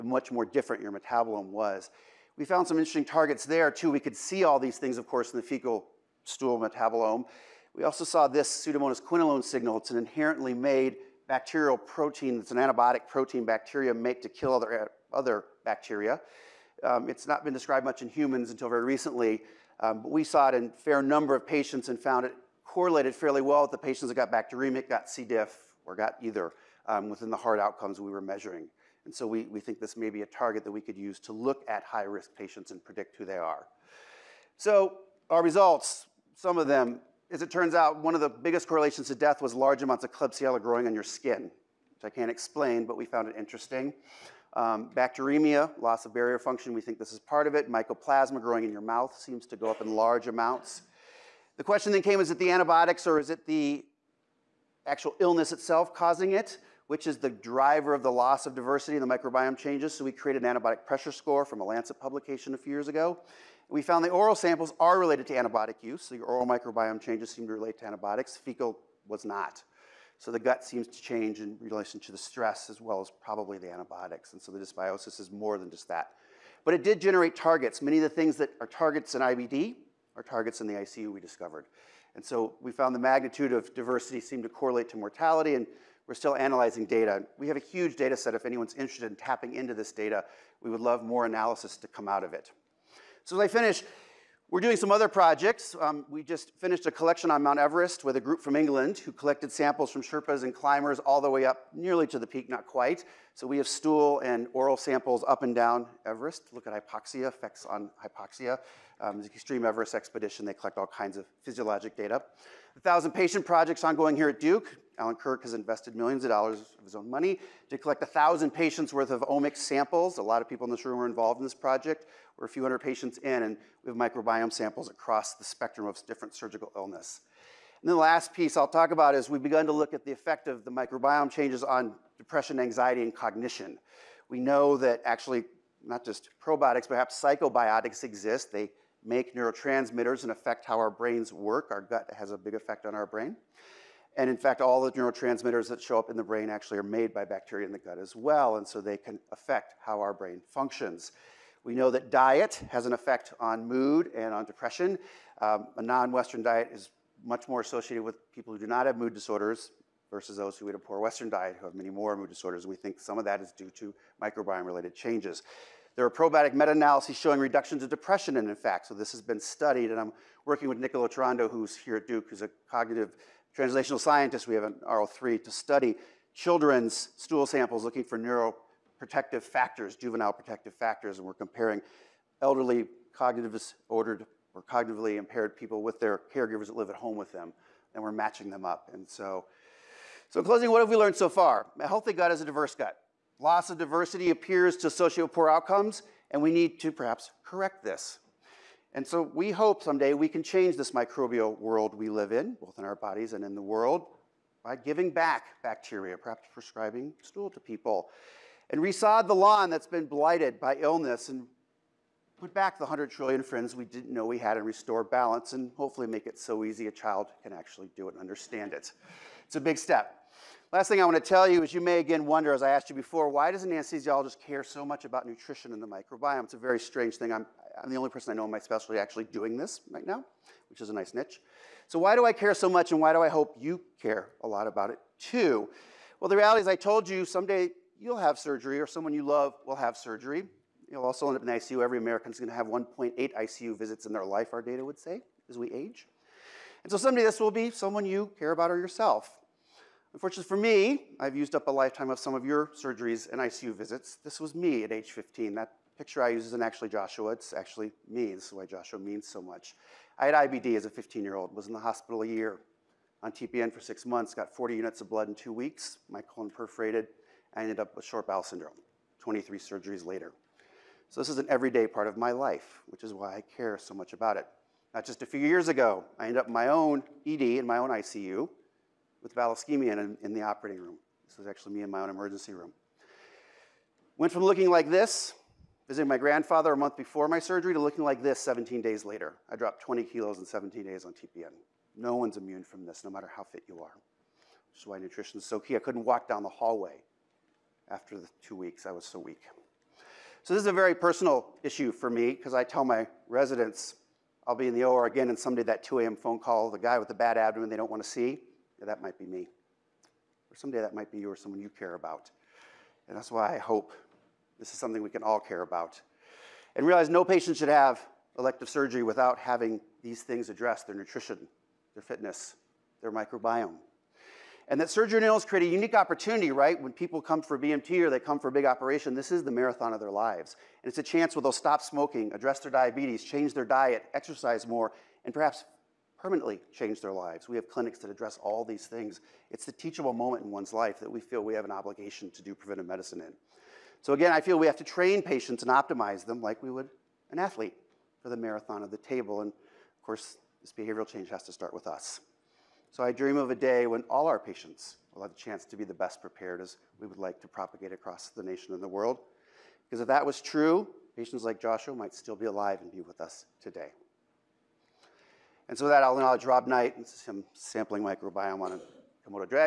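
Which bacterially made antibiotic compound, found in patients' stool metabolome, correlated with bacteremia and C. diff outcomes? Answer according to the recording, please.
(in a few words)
Pseudomonas quinolone signal.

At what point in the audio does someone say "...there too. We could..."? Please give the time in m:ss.
0:03.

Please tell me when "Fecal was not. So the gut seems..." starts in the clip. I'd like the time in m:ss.
1:08.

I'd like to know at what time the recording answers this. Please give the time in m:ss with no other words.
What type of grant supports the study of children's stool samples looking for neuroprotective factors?
2:54.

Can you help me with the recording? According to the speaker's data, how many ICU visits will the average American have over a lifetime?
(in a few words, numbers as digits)
1.8.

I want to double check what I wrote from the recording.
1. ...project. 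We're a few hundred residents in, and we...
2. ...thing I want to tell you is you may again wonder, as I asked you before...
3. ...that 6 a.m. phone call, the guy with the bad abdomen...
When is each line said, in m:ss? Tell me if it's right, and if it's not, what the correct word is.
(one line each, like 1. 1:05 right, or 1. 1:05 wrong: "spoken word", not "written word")
1. 2:01 wrong: "patients", not "residents"
2. 3:40 right
3. 5:05 wrong: "2", not "6".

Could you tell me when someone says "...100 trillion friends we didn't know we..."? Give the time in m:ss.
3:32.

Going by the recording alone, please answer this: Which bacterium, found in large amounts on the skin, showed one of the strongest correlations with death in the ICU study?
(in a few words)
Klebsiella.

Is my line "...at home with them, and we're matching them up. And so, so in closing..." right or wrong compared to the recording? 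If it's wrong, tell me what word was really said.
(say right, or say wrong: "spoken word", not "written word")
right.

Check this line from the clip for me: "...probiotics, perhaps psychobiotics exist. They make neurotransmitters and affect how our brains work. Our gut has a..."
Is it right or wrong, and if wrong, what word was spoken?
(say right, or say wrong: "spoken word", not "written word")
right.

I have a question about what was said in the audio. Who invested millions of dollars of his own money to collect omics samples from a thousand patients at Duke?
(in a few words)
Allan Kirk.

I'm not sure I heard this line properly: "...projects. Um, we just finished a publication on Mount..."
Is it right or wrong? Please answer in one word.
wrong.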